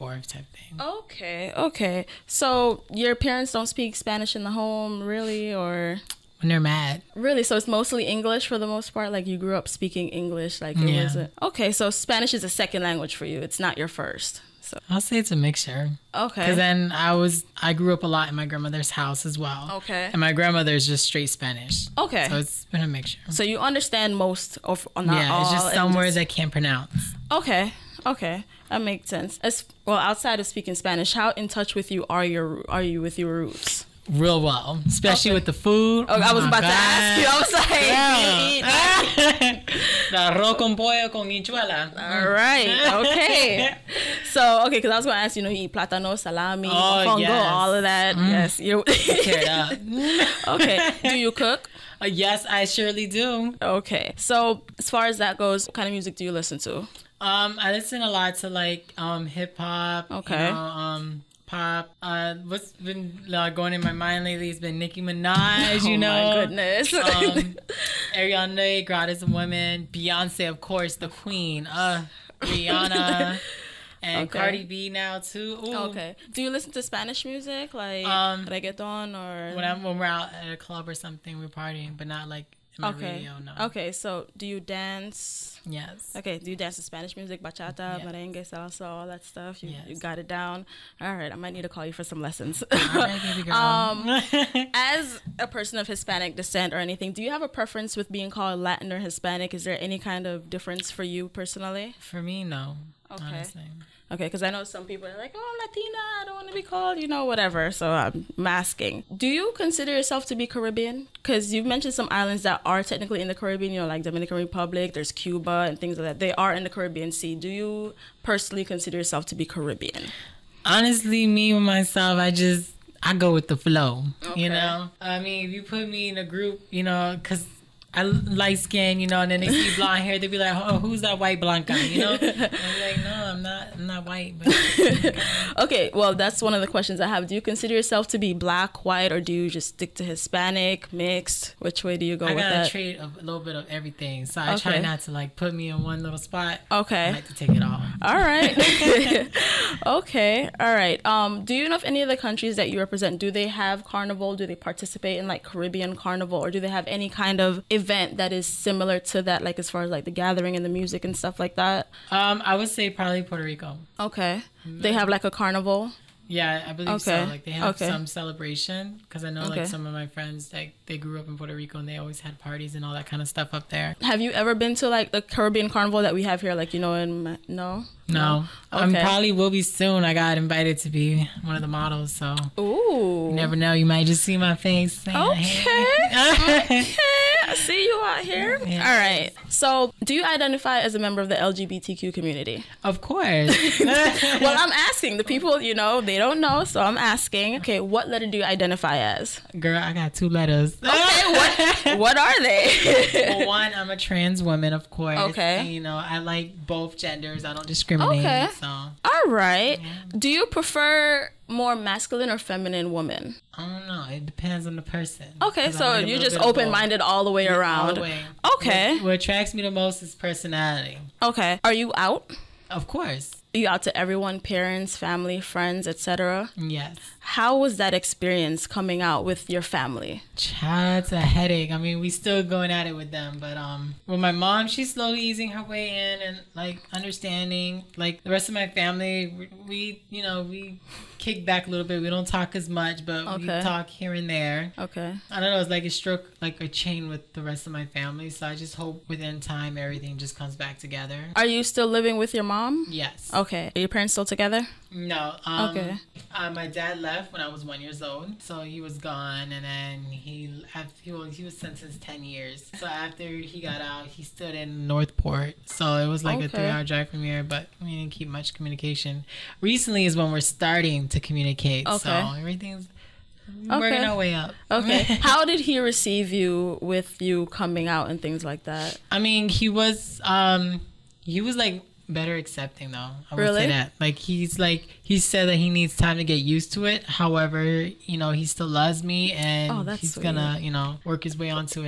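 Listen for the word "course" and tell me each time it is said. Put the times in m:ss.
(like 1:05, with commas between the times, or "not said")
1:10, 3:12, 3:24, 3:42.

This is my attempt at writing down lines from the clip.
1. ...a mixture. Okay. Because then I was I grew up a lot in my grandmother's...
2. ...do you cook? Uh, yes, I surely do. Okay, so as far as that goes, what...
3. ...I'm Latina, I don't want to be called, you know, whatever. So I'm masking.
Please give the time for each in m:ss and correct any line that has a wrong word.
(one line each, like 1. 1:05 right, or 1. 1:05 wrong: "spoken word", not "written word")
1. 0:15 right
2. 0:51 right
3. 1:45 right.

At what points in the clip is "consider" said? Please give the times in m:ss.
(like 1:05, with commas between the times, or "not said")
1:49, 1:58, 2:17.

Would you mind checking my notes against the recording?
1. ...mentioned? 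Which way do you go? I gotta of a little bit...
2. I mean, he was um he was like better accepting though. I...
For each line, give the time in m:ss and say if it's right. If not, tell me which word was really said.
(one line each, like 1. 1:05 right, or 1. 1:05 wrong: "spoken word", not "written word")
1. 2:20 wrong: "mixed", not "mentioned"
2. 4:39 right.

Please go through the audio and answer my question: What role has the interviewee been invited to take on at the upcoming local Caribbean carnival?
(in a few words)
one of the models.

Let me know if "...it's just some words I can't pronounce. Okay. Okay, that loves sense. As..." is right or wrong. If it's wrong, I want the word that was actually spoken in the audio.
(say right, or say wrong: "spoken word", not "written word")
wrong: "makes", not "loves".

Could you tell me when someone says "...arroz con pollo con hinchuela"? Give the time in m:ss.
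0:40.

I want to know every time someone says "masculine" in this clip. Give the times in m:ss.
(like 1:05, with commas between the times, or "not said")
3:31.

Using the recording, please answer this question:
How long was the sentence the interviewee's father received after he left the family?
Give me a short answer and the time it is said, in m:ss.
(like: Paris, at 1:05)
10 years, at 4:22.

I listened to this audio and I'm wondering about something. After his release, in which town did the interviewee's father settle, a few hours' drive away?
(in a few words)
North Port.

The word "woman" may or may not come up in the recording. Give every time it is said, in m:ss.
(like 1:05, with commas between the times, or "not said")
1:09, 3:24, 3:32.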